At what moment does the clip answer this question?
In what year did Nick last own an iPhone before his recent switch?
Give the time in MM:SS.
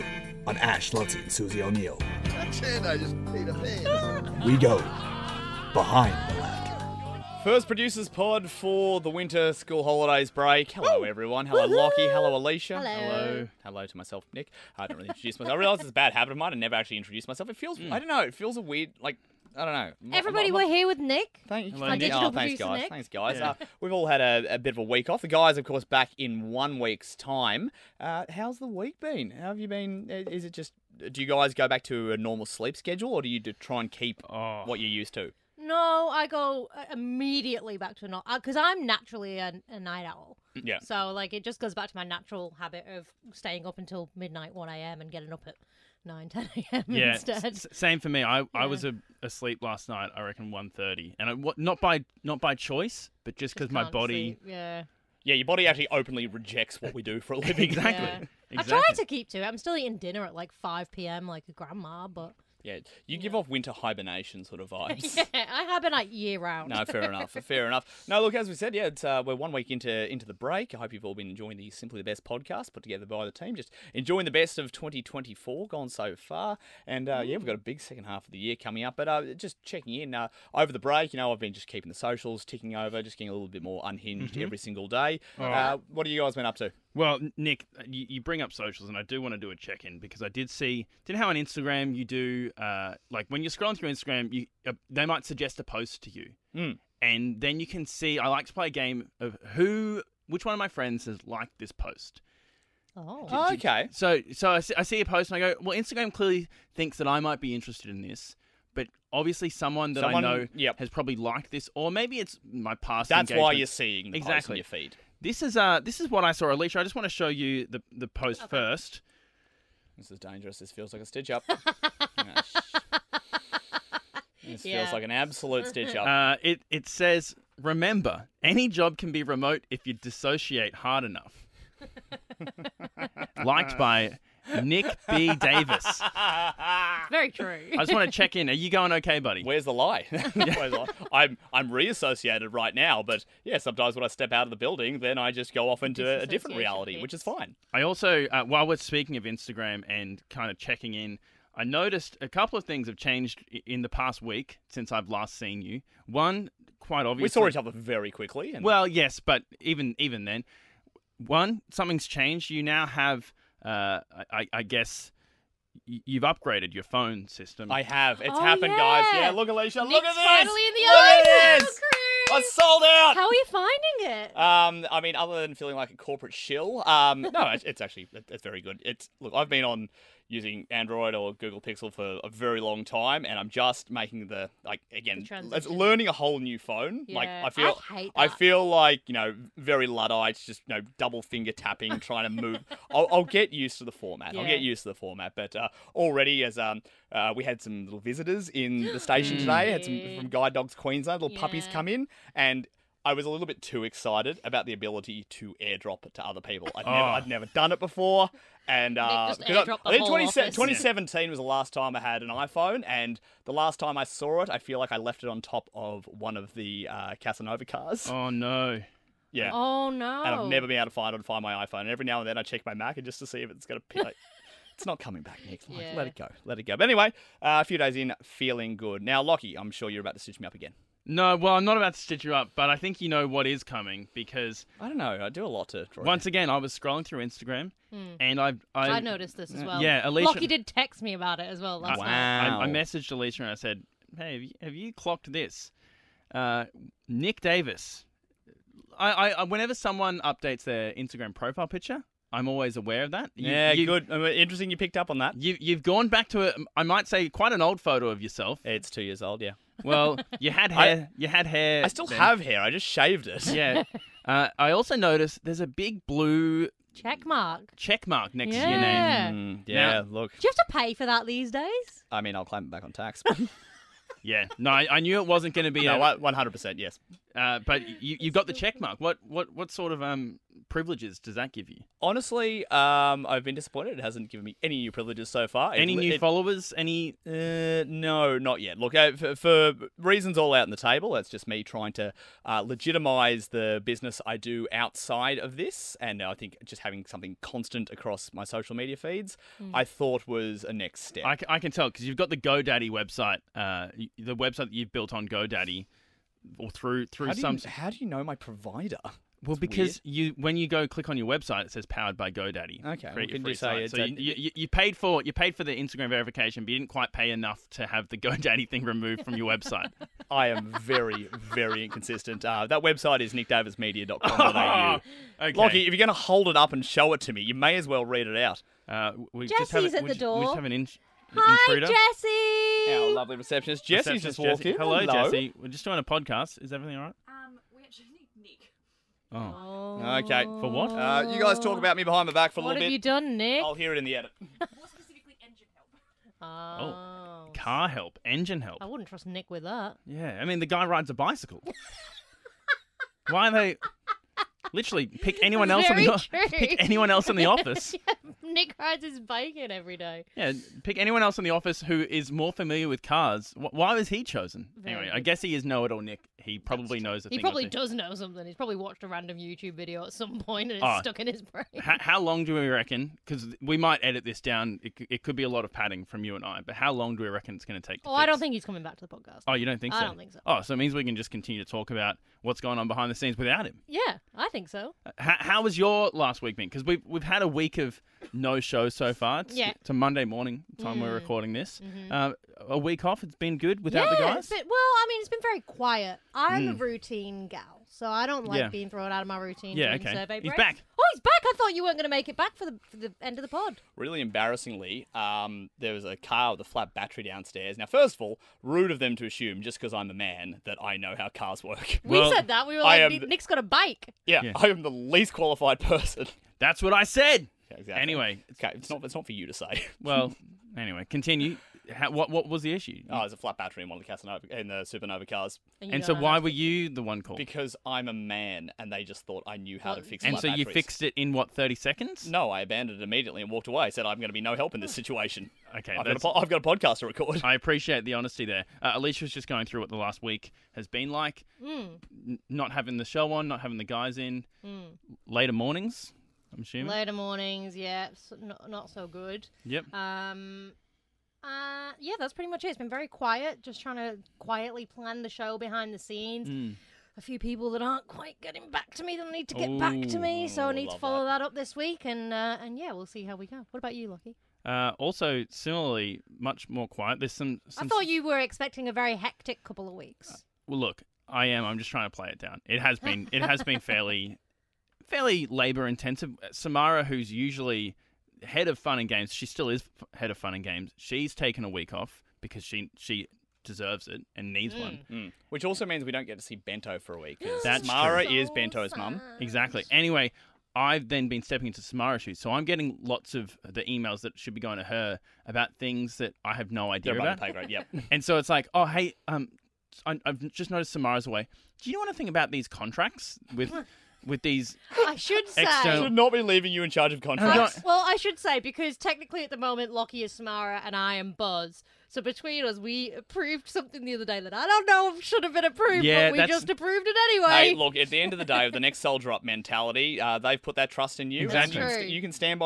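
03:30.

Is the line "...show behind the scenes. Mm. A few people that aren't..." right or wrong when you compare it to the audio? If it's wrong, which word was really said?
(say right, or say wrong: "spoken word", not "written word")
right.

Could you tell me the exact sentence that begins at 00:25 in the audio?
The guys, of course, back in one week's time.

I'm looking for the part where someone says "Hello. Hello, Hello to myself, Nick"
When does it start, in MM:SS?
00:12.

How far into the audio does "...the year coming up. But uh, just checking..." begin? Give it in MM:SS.
01:18.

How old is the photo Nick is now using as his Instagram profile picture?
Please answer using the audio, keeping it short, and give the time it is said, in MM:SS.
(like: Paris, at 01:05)
Two years, at 04:18.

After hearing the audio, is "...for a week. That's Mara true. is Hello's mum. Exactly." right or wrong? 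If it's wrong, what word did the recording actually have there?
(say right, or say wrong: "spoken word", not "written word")
wrong: "Bento", not "Hello".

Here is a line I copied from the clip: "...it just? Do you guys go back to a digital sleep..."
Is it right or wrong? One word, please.
wrong.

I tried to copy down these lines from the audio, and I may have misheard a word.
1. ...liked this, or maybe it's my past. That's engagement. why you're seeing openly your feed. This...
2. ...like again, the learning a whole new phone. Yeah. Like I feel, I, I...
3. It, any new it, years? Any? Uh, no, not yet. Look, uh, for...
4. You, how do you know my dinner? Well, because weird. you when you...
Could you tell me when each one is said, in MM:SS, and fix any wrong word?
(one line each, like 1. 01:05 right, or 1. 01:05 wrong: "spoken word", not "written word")
1. 01:51 wrong: "exactly", not "openly"
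2. 03:04 right
3. 04:45 wrong: "followers", not "years"
4. 05:07 wrong: "provider", not "dinner".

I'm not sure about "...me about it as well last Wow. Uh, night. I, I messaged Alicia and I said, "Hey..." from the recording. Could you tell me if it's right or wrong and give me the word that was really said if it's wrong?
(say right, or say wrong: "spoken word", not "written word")
right.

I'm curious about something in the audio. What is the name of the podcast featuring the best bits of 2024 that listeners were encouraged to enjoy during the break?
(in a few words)
Simply the Best.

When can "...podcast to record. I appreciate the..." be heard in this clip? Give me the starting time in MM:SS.
07:16.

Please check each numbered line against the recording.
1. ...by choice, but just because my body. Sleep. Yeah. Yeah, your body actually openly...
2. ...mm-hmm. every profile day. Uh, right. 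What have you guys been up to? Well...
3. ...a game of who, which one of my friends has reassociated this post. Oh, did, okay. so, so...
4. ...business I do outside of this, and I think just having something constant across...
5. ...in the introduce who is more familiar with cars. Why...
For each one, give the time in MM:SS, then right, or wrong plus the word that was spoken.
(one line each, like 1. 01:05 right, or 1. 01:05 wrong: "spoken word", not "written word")
1. 00:52 right
2. 01:24 wrong: "single", not "profile"
3. 01:38 wrong: "liked", not "reassociated"
4. 04:53 right
5. 06:01 wrong: "office", not "introduce".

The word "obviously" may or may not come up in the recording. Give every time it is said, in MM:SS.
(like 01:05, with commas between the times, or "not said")
01:49, 02:37.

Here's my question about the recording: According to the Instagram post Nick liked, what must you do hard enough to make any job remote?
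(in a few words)
dissociate.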